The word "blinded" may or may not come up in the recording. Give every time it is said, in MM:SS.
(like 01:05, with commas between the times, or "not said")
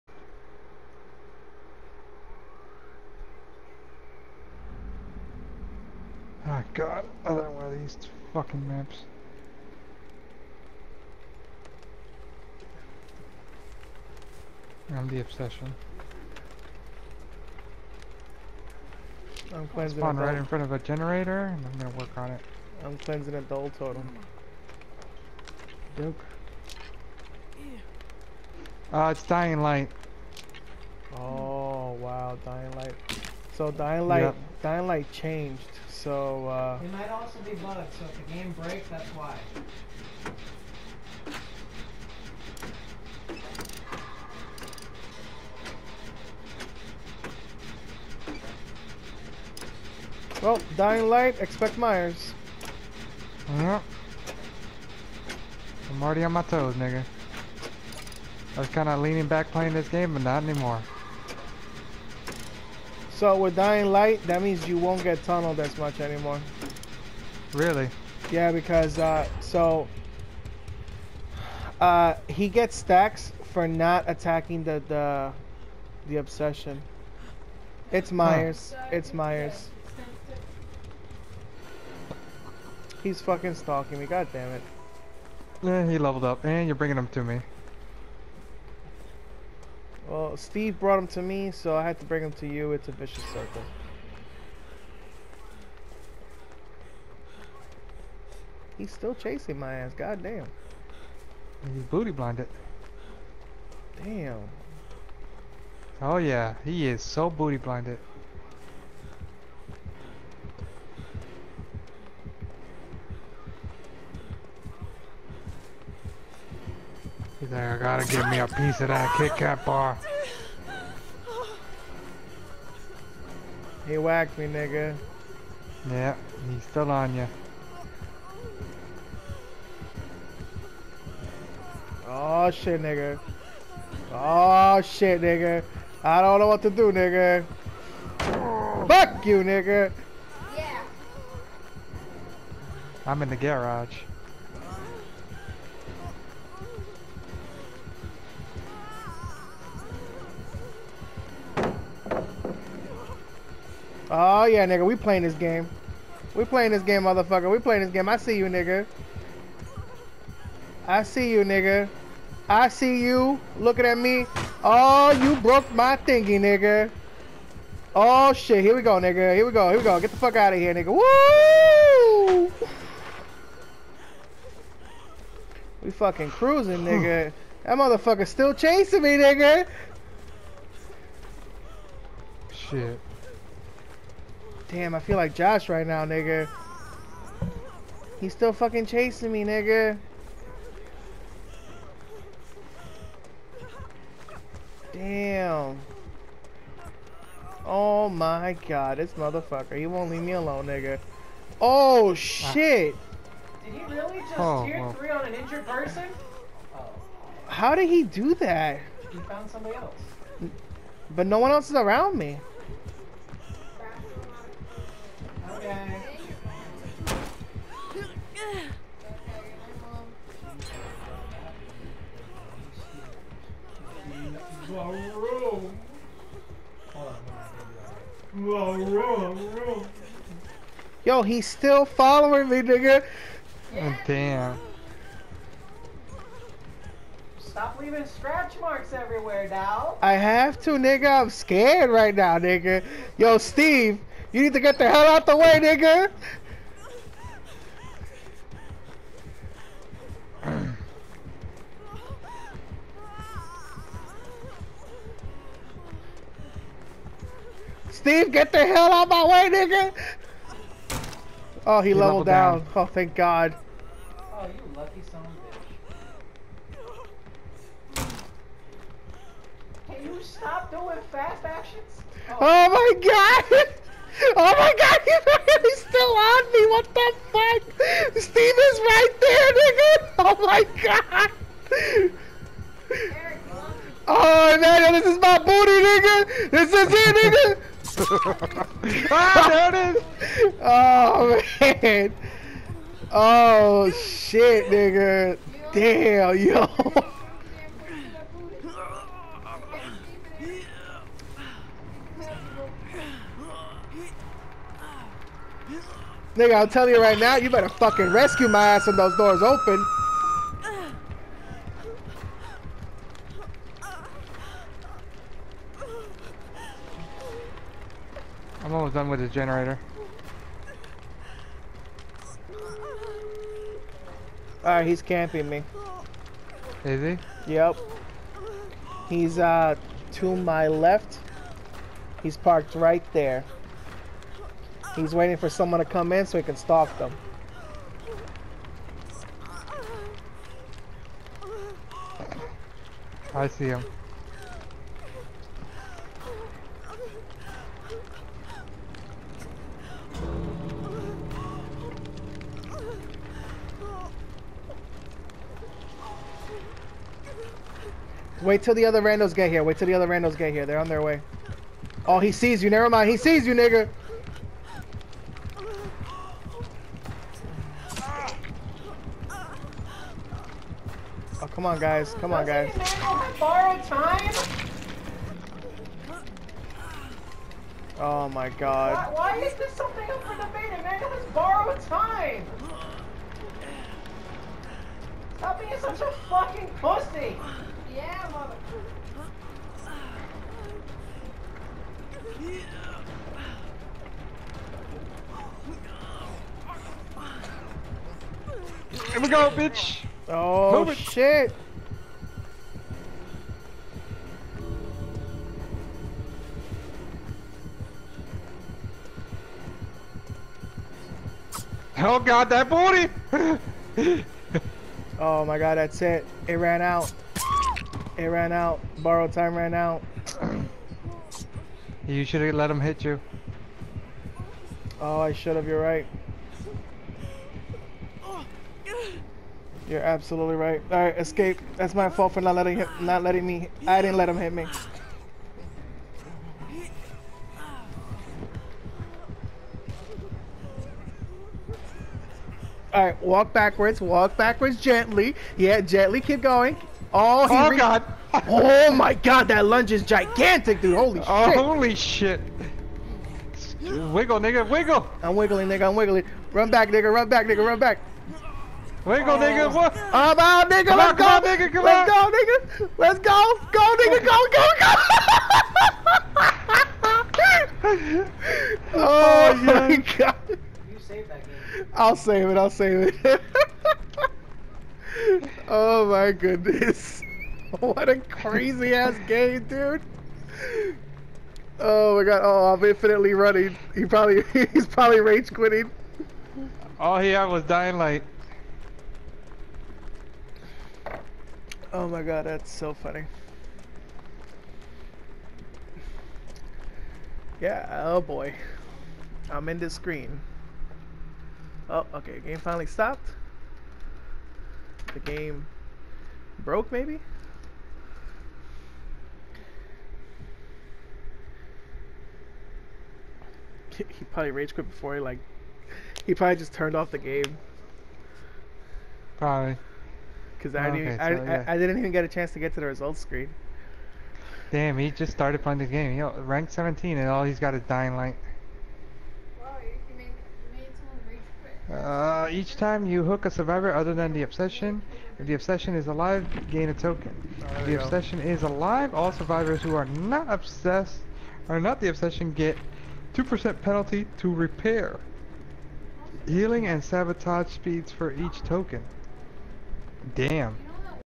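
01:42, 01:47.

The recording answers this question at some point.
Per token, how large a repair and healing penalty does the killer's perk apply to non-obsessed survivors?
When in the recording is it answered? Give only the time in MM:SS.
09:03.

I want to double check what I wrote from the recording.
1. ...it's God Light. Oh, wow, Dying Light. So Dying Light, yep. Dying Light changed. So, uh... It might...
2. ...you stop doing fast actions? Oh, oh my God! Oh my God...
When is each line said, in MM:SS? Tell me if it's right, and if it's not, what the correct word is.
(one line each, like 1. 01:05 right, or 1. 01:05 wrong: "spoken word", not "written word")
1. 00:29 wrong: "Dying", not "God"
2. 04:30 right.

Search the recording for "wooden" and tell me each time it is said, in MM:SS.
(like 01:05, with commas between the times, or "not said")
not said.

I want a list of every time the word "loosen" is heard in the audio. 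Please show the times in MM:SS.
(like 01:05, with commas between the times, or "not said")
not said.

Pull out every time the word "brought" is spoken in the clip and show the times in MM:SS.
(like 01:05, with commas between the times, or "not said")
01:30.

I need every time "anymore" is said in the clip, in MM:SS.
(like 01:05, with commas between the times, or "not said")
01:00, 01:06.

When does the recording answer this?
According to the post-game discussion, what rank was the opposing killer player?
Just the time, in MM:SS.
08:46.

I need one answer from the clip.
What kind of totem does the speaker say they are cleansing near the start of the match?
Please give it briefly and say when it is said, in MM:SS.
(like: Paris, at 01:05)
Dull totem, at 00:23.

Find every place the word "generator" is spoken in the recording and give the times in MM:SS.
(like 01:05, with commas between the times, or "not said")
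00:20, 05:19.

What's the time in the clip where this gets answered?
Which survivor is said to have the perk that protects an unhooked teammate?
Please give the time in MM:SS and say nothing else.
06:20.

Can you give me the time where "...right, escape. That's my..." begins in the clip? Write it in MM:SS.
07:11.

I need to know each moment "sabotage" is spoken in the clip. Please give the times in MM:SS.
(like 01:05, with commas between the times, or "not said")
09:07.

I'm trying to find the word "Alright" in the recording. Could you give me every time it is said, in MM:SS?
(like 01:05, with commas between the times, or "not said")
05:24.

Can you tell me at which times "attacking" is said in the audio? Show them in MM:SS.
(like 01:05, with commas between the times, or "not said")
01:14.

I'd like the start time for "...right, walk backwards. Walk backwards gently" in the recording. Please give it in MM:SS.
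07:23.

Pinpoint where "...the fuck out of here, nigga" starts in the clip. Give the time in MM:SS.
02:50.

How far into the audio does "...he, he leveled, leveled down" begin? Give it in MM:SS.
04:21.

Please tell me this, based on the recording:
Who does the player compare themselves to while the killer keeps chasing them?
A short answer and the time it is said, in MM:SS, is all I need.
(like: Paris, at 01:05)
Josh, at 03:04.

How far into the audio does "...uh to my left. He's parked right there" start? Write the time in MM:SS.
05:29.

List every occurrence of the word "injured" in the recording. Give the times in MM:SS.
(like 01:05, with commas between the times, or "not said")
03:25.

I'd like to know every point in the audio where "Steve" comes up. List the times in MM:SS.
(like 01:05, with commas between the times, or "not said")
01:30, 04:03, 04:18, 04:38.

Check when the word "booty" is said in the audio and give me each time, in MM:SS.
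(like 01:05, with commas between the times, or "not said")
01:41, 01:47, 04:45, 06:52.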